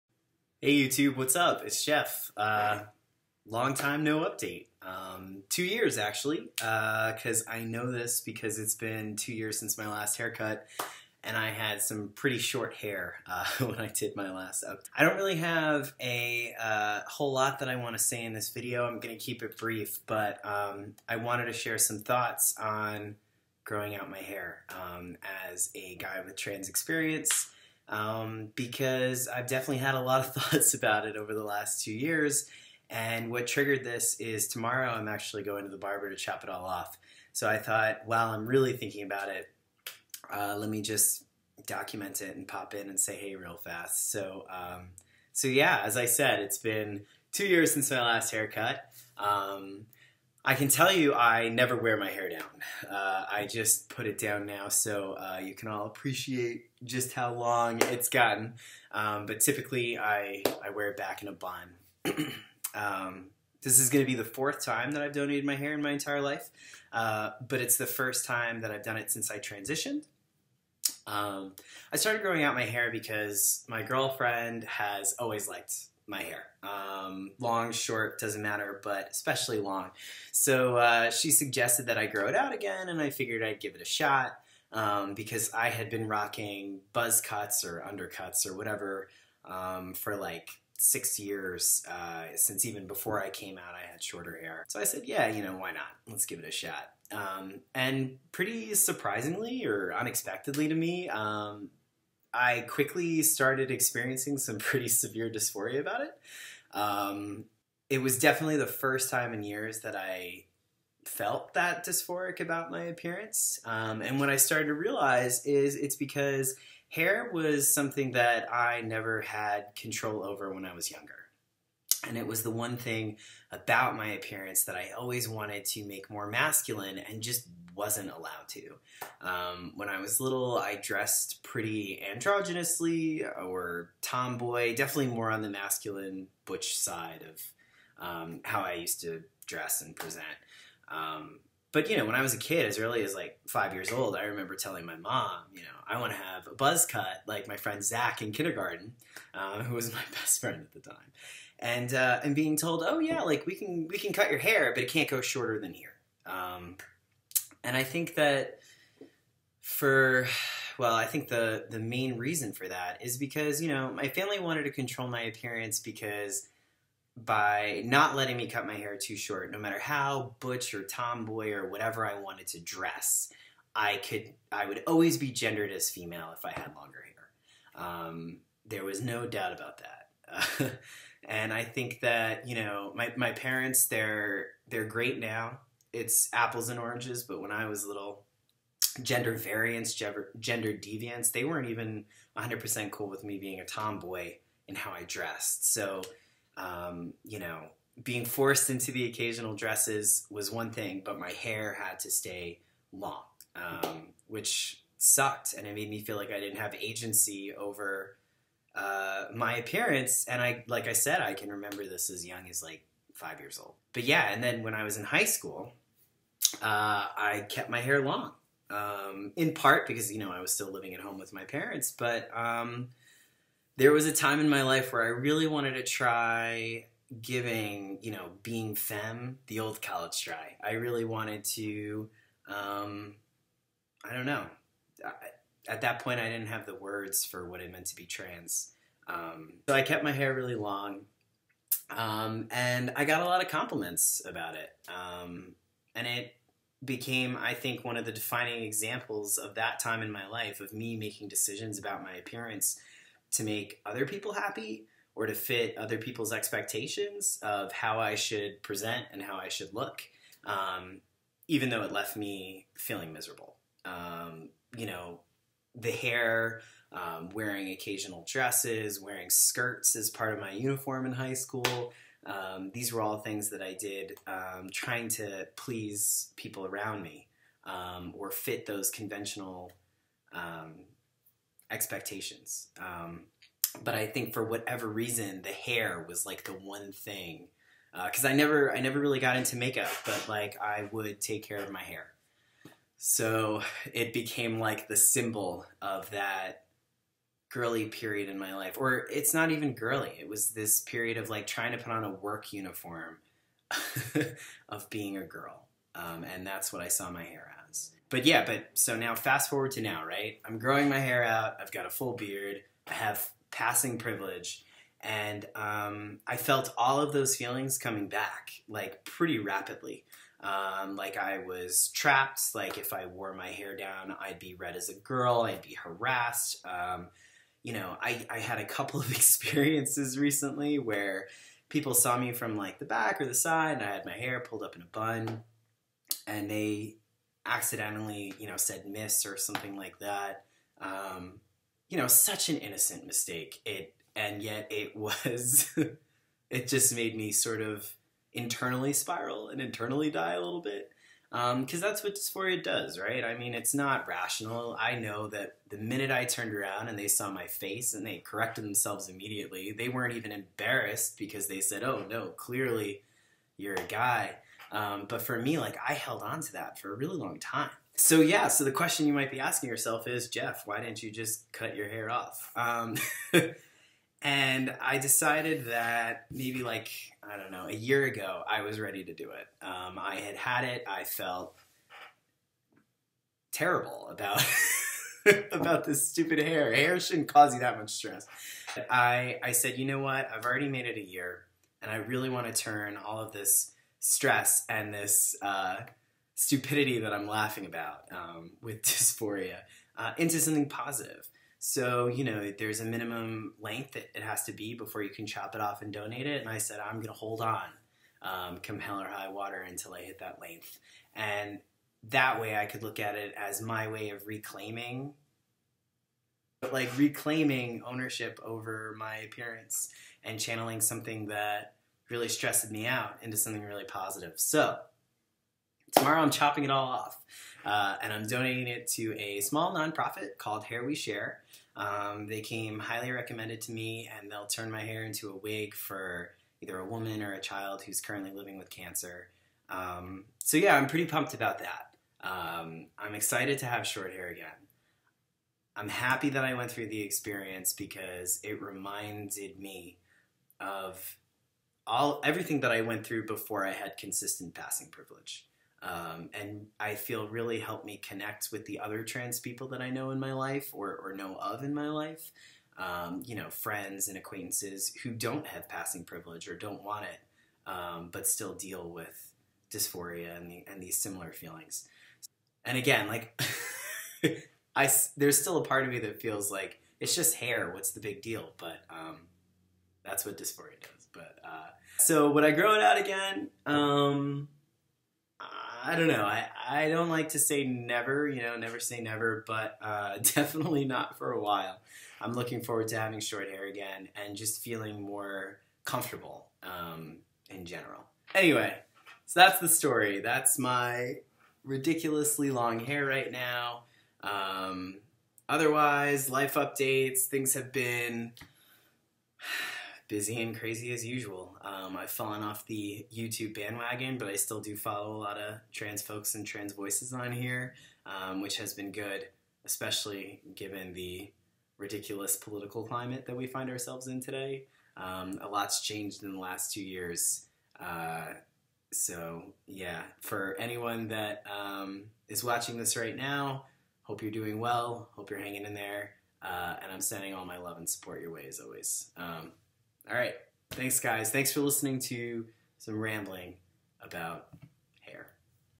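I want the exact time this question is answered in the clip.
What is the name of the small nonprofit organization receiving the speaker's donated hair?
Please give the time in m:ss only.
7:10.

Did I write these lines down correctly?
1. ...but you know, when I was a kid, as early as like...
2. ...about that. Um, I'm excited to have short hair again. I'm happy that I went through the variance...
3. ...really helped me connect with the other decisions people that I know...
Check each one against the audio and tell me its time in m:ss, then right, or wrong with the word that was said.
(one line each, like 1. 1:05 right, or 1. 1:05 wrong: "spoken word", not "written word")
1. 2:21 right
2. 7:21 wrong: "experience", not "variance"
3. 7:37 wrong: "trans", not "decisions".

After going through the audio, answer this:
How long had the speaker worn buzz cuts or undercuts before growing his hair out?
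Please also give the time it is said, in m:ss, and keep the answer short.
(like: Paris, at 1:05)
6 years, at 1:30.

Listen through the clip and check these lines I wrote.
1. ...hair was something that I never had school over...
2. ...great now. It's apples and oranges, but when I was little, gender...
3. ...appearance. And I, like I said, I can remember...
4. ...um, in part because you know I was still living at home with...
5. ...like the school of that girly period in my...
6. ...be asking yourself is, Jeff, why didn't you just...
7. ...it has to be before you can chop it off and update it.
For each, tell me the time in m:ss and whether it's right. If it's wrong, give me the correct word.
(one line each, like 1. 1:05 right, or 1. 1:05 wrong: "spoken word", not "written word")
1. 1:56 wrong: "control", not "school"
2. 3:04 right
3. 3:29 right
4. 3:38 right
5. 4:54 wrong: "symbol", not "school"
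6. 6:09 right
7. 6:44 wrong: "donate", not "update".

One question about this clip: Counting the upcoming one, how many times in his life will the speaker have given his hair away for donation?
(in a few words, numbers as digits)
fourth.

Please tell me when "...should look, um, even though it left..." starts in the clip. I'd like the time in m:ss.
4:19.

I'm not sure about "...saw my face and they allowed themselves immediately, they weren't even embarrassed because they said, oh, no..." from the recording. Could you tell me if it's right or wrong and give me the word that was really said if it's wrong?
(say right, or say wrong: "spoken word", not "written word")
wrong: "corrected", not "allowed".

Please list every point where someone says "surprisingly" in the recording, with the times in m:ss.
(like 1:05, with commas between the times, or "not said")
1:38.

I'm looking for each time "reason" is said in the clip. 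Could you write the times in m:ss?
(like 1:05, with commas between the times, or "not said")
2:42, 4:44.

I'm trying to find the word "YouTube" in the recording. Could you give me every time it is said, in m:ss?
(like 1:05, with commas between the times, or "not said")
0:00, 8:33.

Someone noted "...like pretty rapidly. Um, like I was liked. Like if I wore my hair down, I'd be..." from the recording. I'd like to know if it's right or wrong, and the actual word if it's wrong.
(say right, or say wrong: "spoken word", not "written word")
wrong: "trapped", not "liked".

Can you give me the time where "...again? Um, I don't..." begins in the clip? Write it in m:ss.
8:02.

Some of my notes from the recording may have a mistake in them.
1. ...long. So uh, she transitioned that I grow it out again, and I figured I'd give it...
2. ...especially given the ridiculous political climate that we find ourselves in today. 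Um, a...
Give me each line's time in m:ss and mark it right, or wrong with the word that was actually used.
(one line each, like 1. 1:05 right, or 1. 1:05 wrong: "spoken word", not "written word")
1. 1:19 wrong: "suggested", not "transitioned"
2. 8:39 right.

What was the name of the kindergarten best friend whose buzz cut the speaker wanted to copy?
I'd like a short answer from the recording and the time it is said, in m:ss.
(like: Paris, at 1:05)
Zach, at 2:27.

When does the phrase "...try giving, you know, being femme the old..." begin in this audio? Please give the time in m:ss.
3:45.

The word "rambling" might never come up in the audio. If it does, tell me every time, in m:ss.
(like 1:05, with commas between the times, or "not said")
9:02.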